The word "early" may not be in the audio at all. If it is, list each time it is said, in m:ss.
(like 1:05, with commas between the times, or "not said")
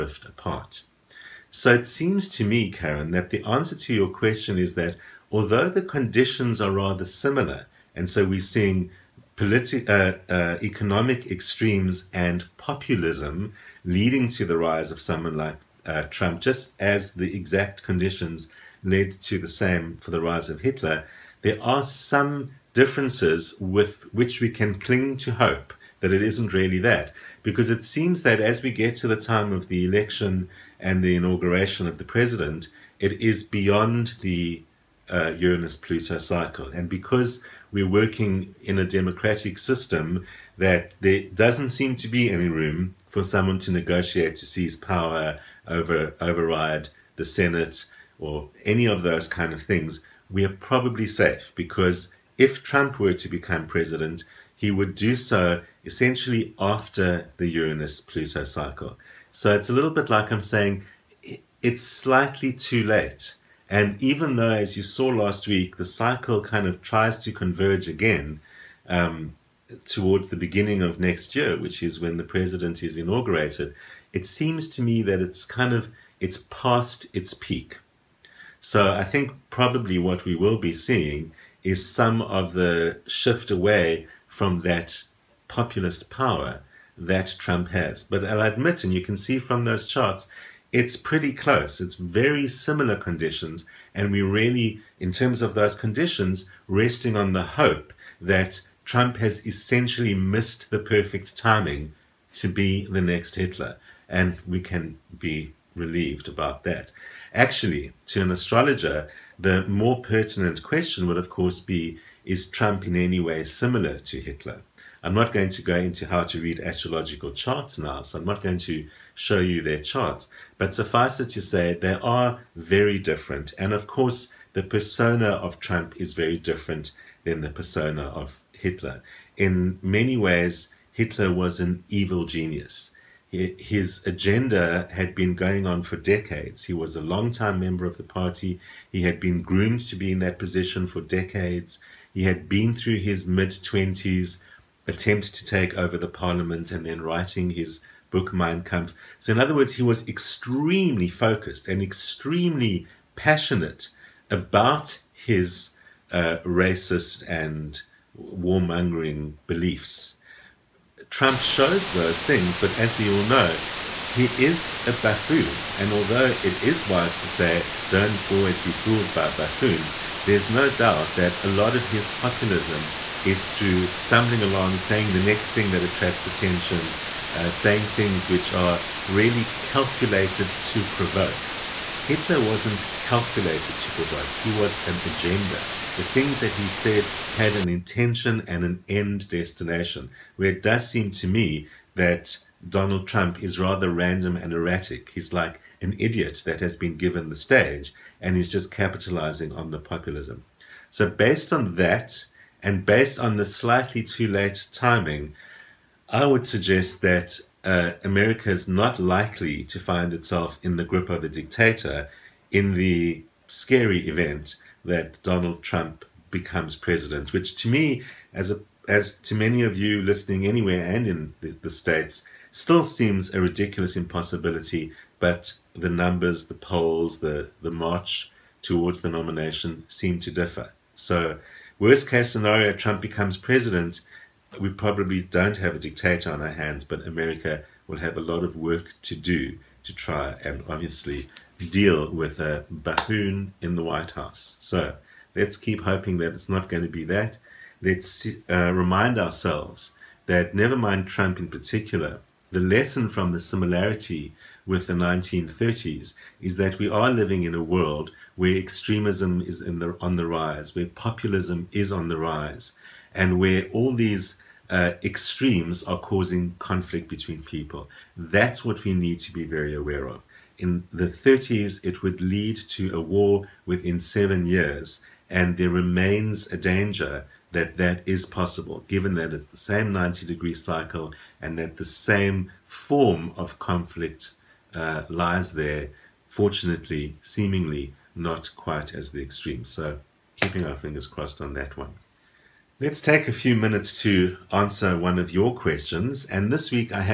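not said.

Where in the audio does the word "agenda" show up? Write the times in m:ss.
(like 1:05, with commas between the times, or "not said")
2:14, 3:05.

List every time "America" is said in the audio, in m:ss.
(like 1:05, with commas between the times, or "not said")
3:28, 3:57.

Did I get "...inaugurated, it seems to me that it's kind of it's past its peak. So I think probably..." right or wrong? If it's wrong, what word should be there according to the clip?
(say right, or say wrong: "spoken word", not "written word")
right.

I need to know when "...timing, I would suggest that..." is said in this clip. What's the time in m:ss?
3:24.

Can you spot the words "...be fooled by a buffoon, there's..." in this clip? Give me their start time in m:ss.
2:48.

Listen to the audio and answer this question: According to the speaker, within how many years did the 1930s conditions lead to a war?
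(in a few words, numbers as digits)
7 years.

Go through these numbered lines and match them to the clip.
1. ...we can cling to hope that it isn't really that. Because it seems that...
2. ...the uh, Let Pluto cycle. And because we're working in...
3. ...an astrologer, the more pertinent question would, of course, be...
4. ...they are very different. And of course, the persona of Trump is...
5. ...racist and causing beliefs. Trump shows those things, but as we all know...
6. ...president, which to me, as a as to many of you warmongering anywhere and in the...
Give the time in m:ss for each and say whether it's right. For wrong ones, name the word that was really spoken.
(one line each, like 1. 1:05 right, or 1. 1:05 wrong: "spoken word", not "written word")
1. 0:24 right
2. 0:34 wrong: "Uranus", not "Let"
3. 1:48 right
4. 2:01 right
5. 2:36 wrong: "warmongering", not "causing"
6. 3:36 wrong: "listening", not "warmongering".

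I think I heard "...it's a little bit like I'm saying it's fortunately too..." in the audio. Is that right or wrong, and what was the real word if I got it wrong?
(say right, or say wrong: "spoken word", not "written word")
wrong: "slightly", not "fortunately".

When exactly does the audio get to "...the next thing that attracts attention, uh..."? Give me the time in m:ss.
2:55.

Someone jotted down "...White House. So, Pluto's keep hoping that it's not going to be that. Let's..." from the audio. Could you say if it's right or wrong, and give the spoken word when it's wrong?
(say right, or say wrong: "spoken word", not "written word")
wrong: "Let", not "Pluto".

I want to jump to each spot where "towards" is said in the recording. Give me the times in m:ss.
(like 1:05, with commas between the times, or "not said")
1:09, 3:48.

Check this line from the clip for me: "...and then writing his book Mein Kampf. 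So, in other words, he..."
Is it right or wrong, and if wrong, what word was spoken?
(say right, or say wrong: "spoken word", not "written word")
right.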